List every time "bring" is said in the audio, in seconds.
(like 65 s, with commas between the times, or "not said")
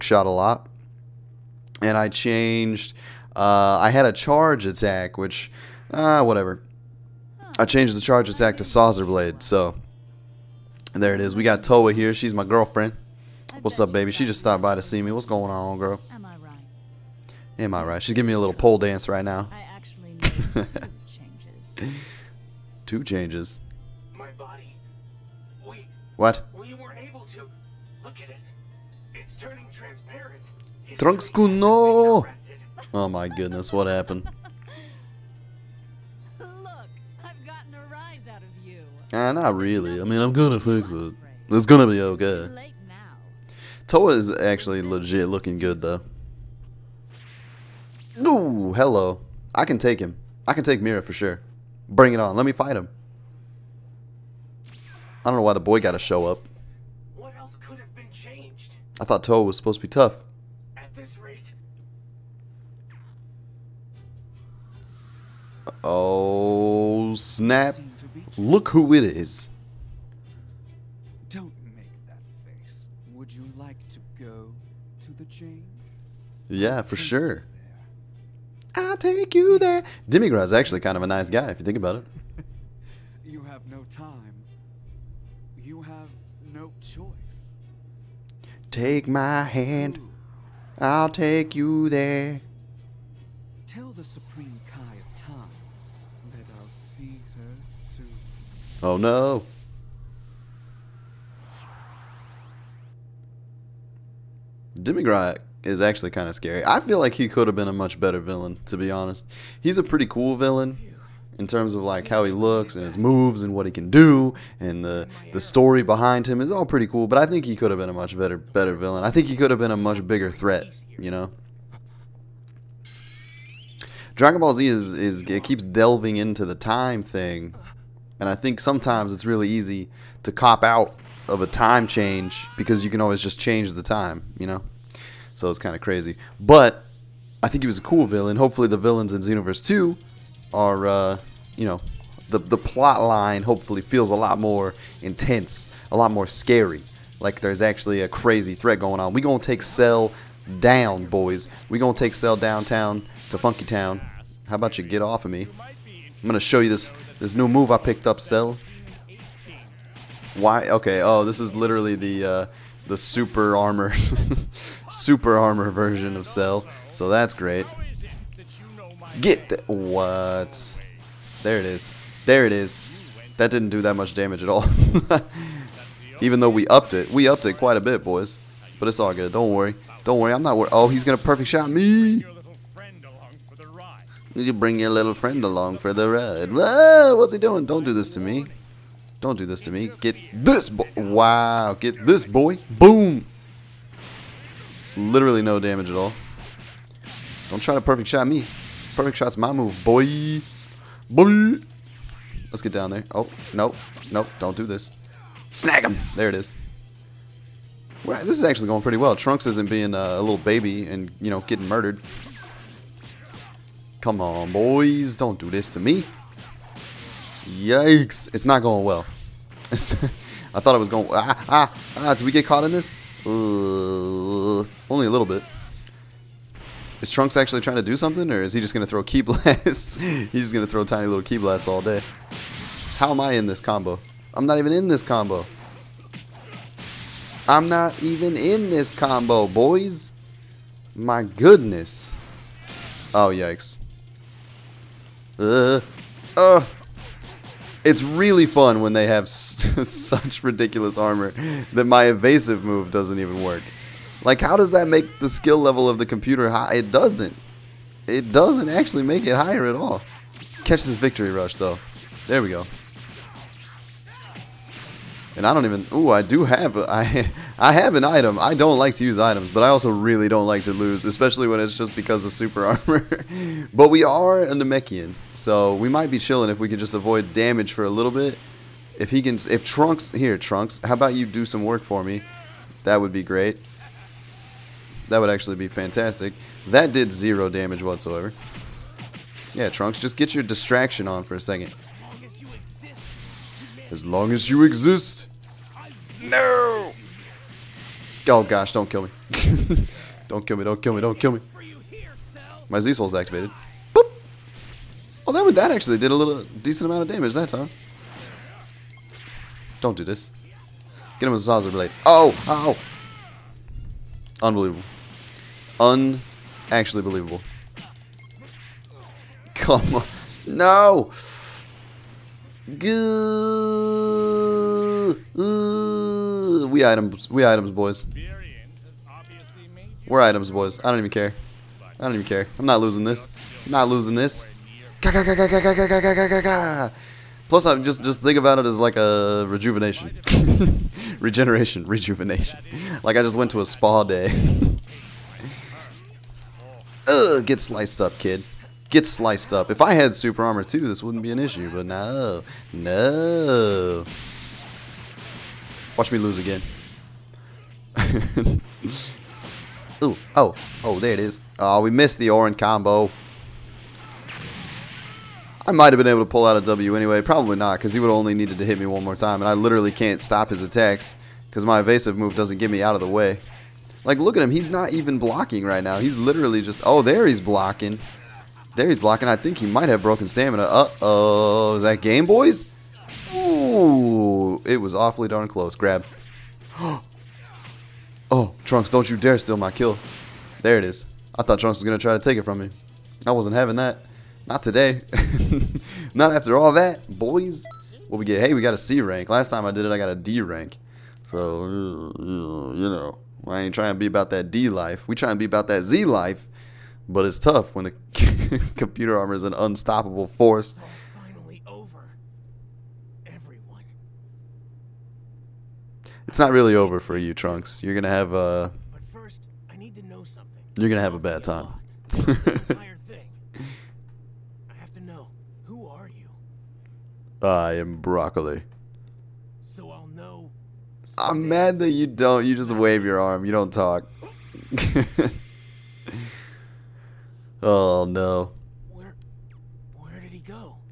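51 s, 184 s.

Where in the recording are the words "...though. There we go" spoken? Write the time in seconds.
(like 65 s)
261 s.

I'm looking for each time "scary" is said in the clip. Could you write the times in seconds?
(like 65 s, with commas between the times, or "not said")
106 s, 146 s.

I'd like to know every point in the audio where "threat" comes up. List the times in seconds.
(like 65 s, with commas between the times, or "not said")
120 s, 148 s.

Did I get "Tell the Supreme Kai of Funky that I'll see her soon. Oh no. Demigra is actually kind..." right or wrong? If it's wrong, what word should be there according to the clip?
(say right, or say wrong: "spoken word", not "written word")
wrong: "Time", not "Funky".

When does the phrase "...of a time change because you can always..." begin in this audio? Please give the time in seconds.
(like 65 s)
131 s.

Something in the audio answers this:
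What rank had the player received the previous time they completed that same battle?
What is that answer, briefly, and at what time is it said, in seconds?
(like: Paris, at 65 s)
D rank, at 399 s.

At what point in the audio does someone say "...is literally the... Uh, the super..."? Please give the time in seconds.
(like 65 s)
161 s.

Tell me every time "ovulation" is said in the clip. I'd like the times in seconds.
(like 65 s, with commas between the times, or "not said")
not said.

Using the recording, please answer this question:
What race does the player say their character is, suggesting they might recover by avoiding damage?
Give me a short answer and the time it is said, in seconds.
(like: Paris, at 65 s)
Namekian, at 273 s.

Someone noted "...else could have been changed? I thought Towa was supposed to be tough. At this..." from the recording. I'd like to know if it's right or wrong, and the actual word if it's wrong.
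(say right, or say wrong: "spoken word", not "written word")
right.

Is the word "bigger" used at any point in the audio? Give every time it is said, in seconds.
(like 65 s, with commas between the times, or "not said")
120 s.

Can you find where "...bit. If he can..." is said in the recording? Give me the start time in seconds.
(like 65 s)
278 s.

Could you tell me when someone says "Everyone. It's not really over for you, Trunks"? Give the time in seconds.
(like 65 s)
413 s.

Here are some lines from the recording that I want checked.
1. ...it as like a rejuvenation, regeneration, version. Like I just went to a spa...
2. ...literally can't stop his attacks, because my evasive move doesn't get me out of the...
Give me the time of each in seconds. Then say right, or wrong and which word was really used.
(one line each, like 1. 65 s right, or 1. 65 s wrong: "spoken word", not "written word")
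1. 338 s wrong: "rejuvenation", not "version"
2. 369 s right.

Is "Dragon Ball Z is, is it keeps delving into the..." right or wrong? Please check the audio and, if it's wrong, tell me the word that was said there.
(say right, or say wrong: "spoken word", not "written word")
right.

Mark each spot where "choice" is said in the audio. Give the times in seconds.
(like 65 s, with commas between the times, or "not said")
86 s.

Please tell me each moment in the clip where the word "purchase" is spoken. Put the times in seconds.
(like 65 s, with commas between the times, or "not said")
not said.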